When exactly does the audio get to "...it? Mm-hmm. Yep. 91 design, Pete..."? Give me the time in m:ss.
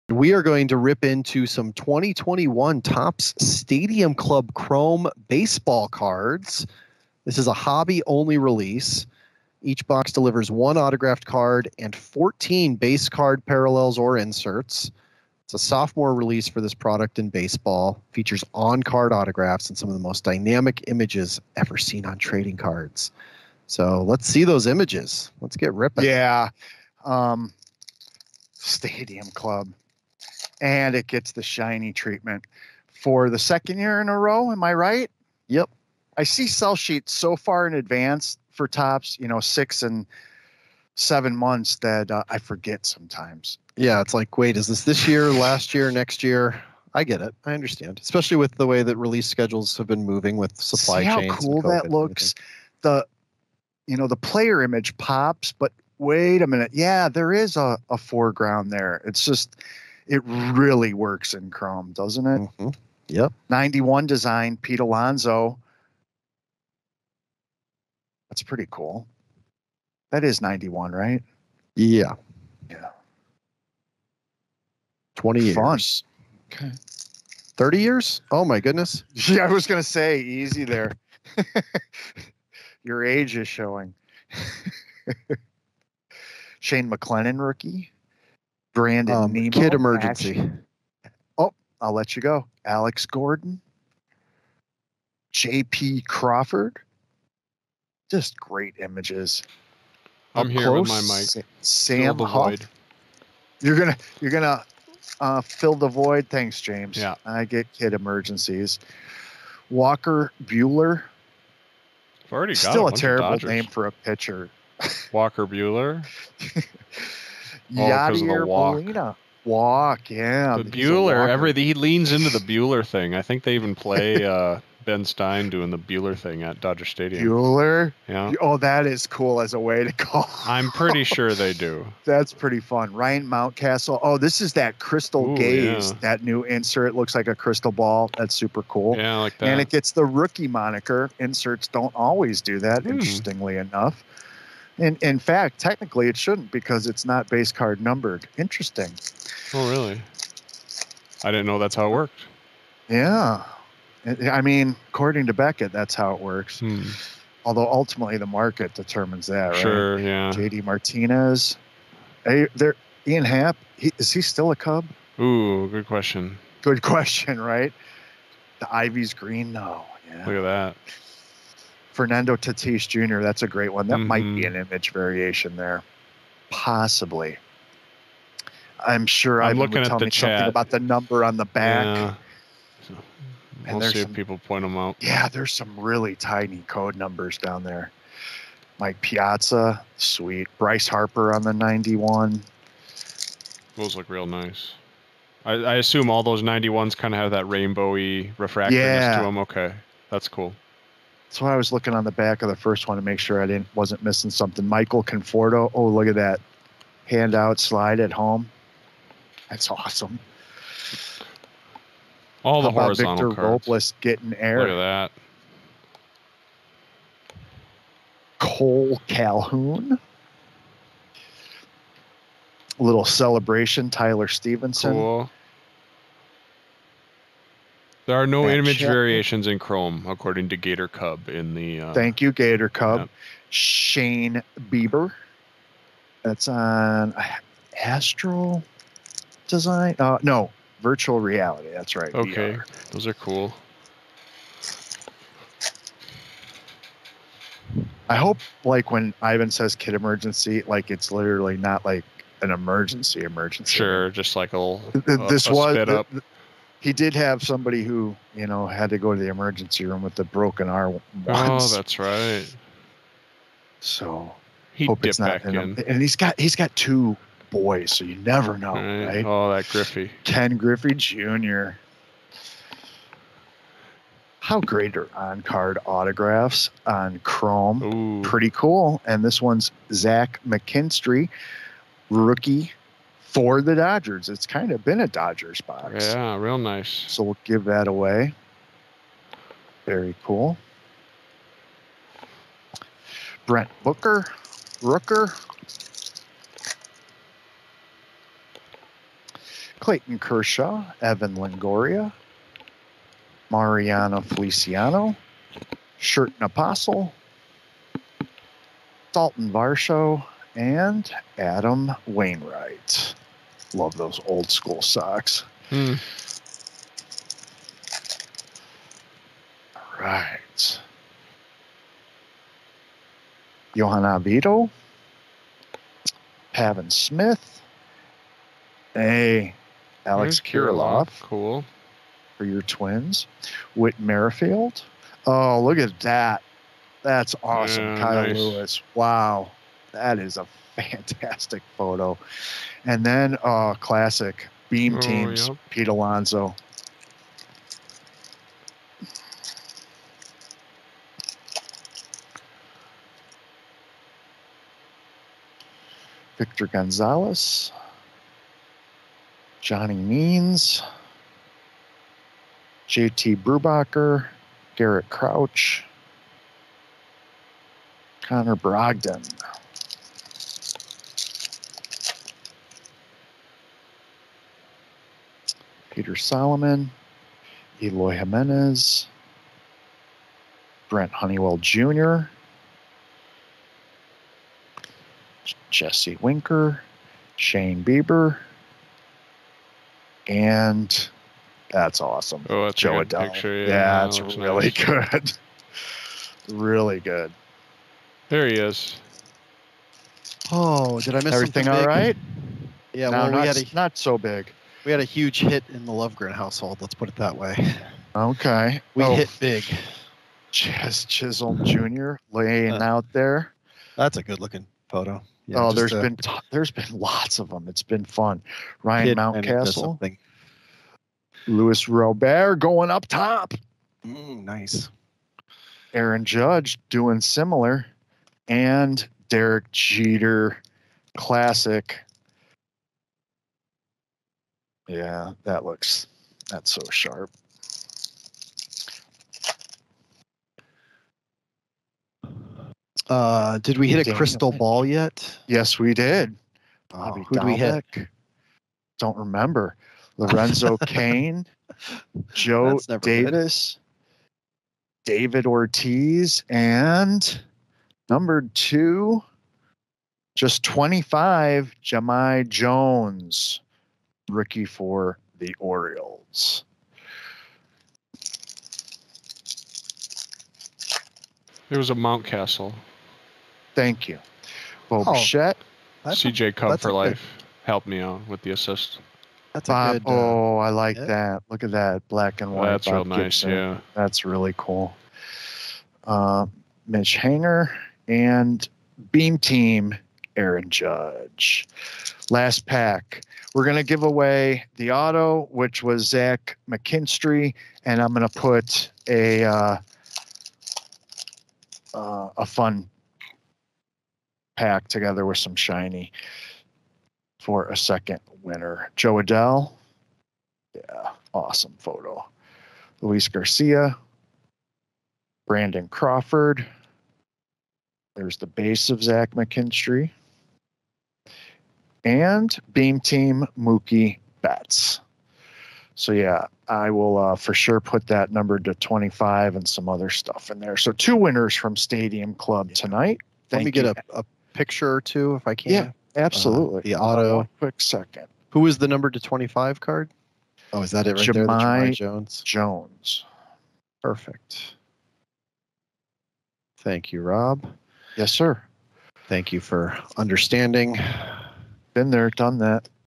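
1:02.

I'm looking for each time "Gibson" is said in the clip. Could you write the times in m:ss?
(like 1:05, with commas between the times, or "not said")
8:03.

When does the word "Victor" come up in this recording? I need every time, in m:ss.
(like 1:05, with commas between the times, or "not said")
3:33, 5:56.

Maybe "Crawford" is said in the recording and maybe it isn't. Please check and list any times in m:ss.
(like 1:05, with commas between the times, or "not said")
1:36, 8:35.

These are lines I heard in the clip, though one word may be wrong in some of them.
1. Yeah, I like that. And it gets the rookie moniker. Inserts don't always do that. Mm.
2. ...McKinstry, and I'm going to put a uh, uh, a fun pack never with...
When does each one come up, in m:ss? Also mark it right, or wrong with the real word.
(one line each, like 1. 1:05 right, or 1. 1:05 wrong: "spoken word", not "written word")
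1. 2:18 right
2. 8:16 wrong: "together", not "never".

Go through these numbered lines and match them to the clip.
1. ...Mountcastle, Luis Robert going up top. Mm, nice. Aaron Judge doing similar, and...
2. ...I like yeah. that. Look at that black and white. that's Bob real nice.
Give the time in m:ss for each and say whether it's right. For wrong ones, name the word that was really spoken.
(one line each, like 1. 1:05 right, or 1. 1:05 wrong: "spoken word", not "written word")
1. 6:59 right
2. 8:00 right.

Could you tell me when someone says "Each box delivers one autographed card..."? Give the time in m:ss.
0:09.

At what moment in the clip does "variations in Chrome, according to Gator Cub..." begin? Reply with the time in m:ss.
3:48.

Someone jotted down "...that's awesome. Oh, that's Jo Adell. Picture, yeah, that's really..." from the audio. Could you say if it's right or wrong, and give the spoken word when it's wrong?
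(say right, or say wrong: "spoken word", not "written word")
right.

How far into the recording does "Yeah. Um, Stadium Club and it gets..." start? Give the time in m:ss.
0:26.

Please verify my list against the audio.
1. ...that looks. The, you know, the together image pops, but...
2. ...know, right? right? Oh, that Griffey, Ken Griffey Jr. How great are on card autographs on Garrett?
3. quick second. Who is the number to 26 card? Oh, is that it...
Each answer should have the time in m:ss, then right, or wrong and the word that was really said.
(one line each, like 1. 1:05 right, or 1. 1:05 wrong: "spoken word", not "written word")
1. 0:51 wrong: "player", not "together"
2. 4:28 wrong: "Chrome", not "Garrett"
3. 8:57 wrong: "25", not "26".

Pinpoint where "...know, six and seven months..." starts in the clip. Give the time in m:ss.
0:39.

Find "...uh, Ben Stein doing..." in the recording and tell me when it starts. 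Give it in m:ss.
2:04.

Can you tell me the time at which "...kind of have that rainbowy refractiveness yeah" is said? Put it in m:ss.
3:16.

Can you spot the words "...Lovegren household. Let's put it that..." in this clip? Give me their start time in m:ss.
6:45.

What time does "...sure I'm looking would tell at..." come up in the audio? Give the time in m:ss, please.
2:59.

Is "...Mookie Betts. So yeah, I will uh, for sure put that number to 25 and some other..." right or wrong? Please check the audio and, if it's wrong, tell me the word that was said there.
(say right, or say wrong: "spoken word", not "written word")
right.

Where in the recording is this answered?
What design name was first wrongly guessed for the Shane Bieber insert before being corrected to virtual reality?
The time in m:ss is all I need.
3:57.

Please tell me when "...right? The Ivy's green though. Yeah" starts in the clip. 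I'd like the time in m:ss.
2:47.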